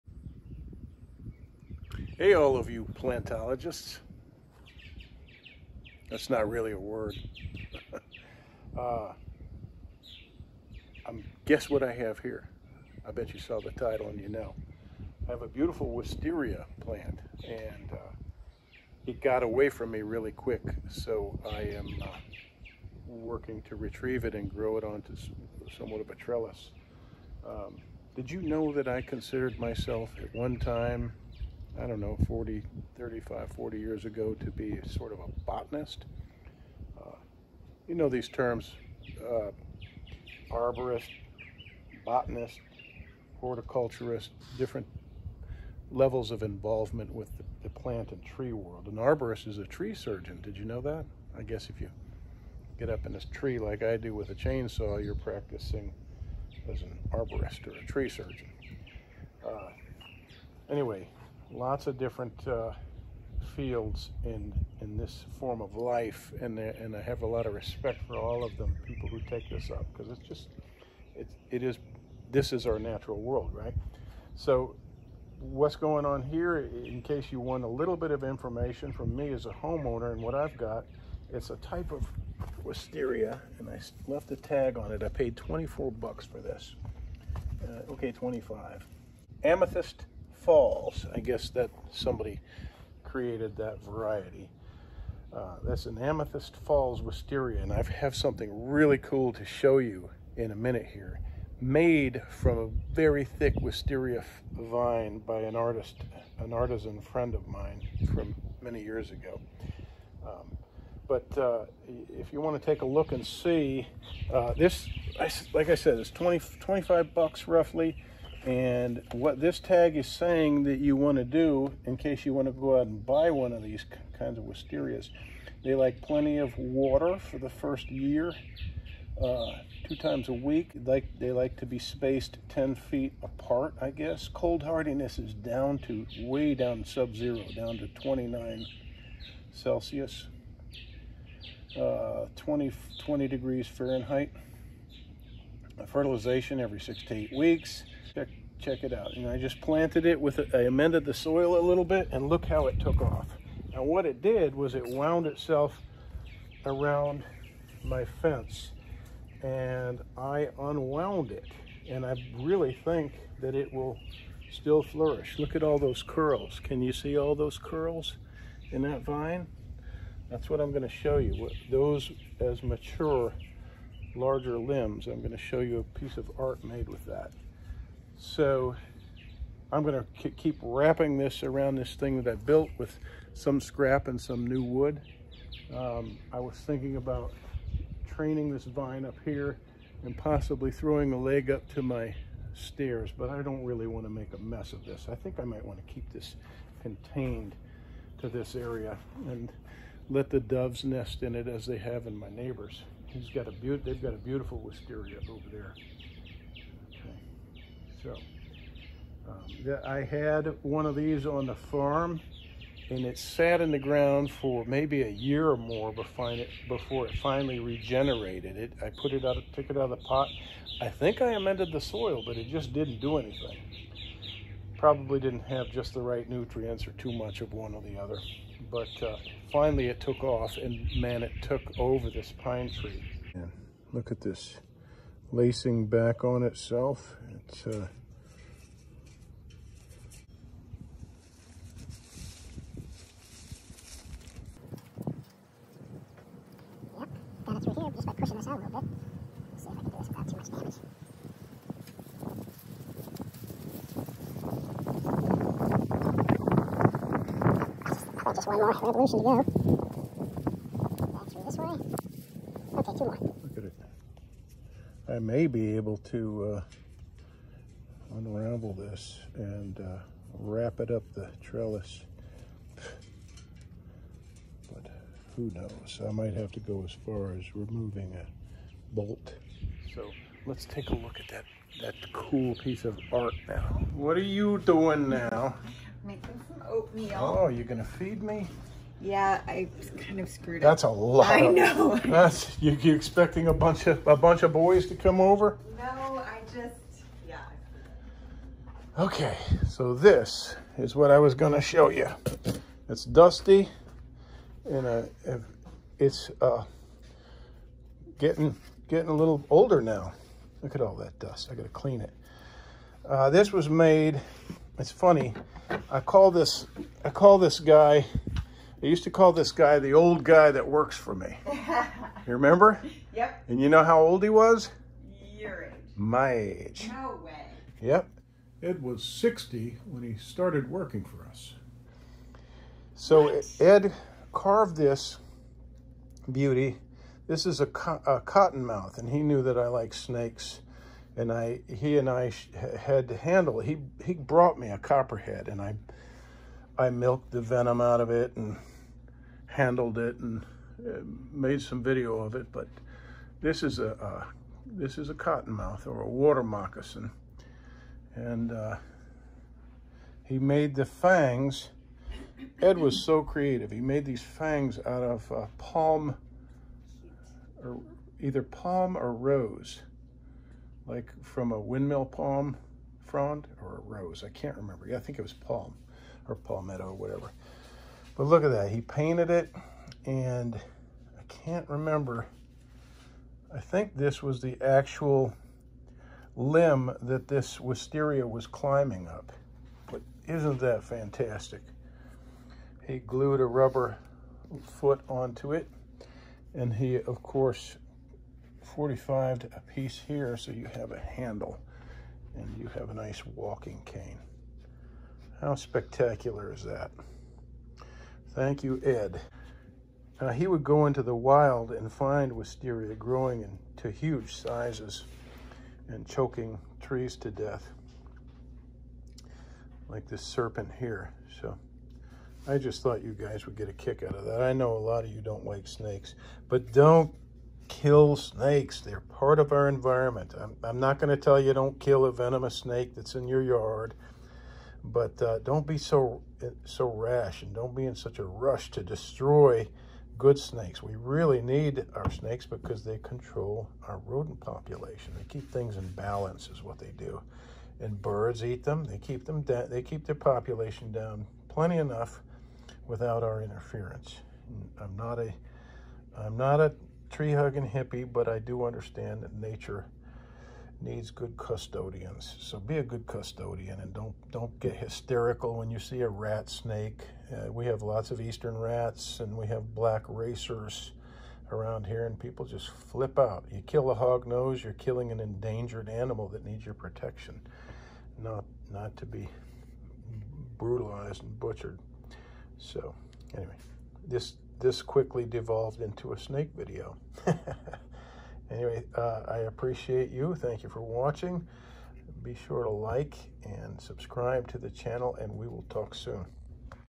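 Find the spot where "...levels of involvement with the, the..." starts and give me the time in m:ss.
0:45.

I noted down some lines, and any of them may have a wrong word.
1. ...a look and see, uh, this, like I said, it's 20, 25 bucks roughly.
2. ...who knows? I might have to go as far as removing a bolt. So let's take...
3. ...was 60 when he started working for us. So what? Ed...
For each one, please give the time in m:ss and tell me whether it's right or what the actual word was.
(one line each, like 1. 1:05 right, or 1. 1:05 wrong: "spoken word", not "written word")
1. 1:52 right
2. 4:35 right
3. 5:28 right.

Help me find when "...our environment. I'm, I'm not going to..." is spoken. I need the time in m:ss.
7:09.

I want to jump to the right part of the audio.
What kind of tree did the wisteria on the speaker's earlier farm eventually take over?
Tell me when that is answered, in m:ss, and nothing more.
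3:52.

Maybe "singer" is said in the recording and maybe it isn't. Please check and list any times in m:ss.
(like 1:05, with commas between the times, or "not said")
not said.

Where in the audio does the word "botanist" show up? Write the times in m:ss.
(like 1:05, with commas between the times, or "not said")
0:35, 0:42.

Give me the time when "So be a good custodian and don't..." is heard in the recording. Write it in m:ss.
7:42.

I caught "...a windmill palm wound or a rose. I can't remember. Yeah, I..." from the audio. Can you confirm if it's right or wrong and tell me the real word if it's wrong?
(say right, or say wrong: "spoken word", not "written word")
wrong: "frond", not "wound".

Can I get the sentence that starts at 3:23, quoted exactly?
He's got a they've got a beautiful wisteria over there.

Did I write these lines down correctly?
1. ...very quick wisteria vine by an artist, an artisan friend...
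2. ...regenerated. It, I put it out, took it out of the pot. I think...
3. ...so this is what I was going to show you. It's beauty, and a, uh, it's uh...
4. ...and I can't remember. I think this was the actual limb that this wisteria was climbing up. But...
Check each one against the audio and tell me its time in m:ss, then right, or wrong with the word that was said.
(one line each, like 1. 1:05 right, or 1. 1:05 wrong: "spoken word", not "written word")
1. 1:42 wrong: "thick", not "quick"
2. 3:37 right
3. 4:59 wrong: "dusty", not "beauty"
4. 6:20 right.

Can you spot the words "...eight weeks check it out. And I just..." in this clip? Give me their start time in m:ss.
2:27.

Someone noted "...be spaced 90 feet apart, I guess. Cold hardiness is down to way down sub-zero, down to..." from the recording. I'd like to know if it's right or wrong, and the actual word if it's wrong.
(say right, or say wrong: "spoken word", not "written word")
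wrong: "10", not "90".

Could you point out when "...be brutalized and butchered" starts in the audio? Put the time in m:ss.
7:59.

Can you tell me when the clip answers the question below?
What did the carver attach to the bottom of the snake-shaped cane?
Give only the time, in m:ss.
6:33.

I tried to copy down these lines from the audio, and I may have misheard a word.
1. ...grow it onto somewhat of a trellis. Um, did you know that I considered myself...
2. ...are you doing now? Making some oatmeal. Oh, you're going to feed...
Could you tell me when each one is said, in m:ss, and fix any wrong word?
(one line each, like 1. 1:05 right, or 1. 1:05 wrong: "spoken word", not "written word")
1. 0:24 right
2. 4:44 right.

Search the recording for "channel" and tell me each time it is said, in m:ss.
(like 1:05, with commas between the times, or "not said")
8:14.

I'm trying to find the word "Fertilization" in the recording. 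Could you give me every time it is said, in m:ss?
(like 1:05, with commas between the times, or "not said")
2:25.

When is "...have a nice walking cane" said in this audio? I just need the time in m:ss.
6:42.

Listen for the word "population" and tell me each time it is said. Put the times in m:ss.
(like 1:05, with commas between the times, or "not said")
7:24, 7:30.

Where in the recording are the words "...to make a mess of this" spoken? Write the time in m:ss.
3:14.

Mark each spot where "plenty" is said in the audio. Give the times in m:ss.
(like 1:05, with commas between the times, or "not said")
2:06, 7:31.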